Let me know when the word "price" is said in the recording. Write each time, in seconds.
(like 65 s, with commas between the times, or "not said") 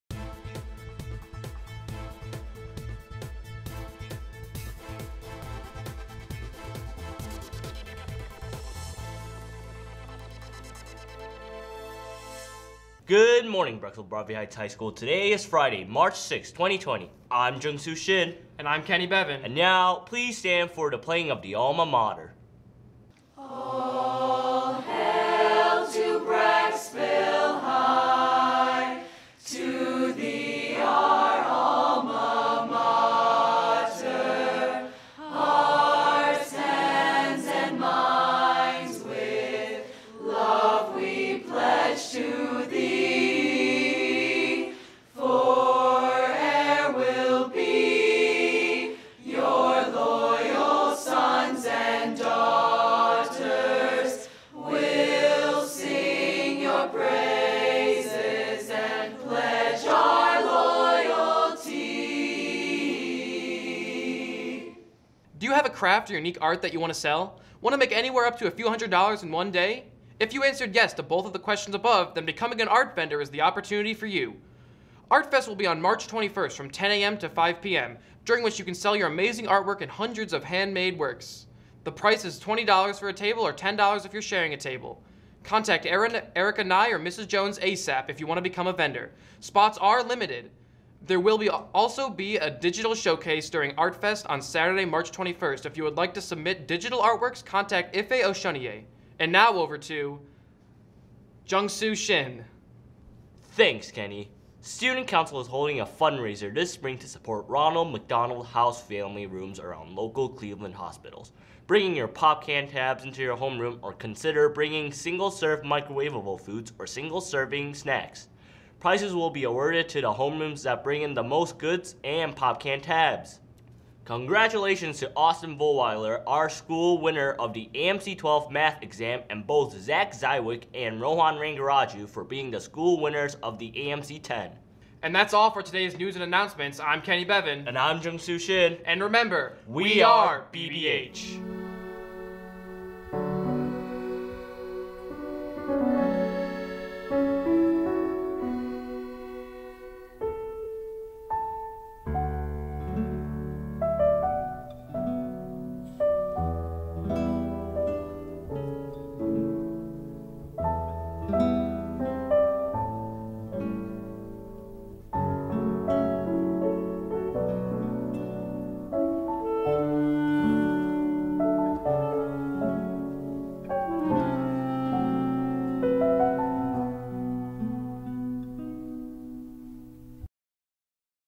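81 s.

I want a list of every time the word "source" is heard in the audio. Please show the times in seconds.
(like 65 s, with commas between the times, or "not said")
not said.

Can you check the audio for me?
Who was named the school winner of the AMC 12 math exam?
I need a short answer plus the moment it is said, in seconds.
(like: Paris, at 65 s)
Austin Volweiler, at 125 s.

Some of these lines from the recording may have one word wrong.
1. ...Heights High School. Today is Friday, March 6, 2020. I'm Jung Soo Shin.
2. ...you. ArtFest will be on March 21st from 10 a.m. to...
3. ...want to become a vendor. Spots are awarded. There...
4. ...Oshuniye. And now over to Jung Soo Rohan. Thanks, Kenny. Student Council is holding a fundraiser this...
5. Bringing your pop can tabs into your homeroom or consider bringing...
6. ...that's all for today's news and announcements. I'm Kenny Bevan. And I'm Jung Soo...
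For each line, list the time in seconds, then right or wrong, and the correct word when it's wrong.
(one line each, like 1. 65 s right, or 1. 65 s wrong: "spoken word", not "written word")
1. 14 s right
2. 74 s right
3. 88 s wrong: "limited", not "awarded"
4. 98 s wrong: "Shin", not "Rohan"
5. 111 s right
6. 135 s right.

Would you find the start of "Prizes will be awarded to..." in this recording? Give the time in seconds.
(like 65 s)
118 s.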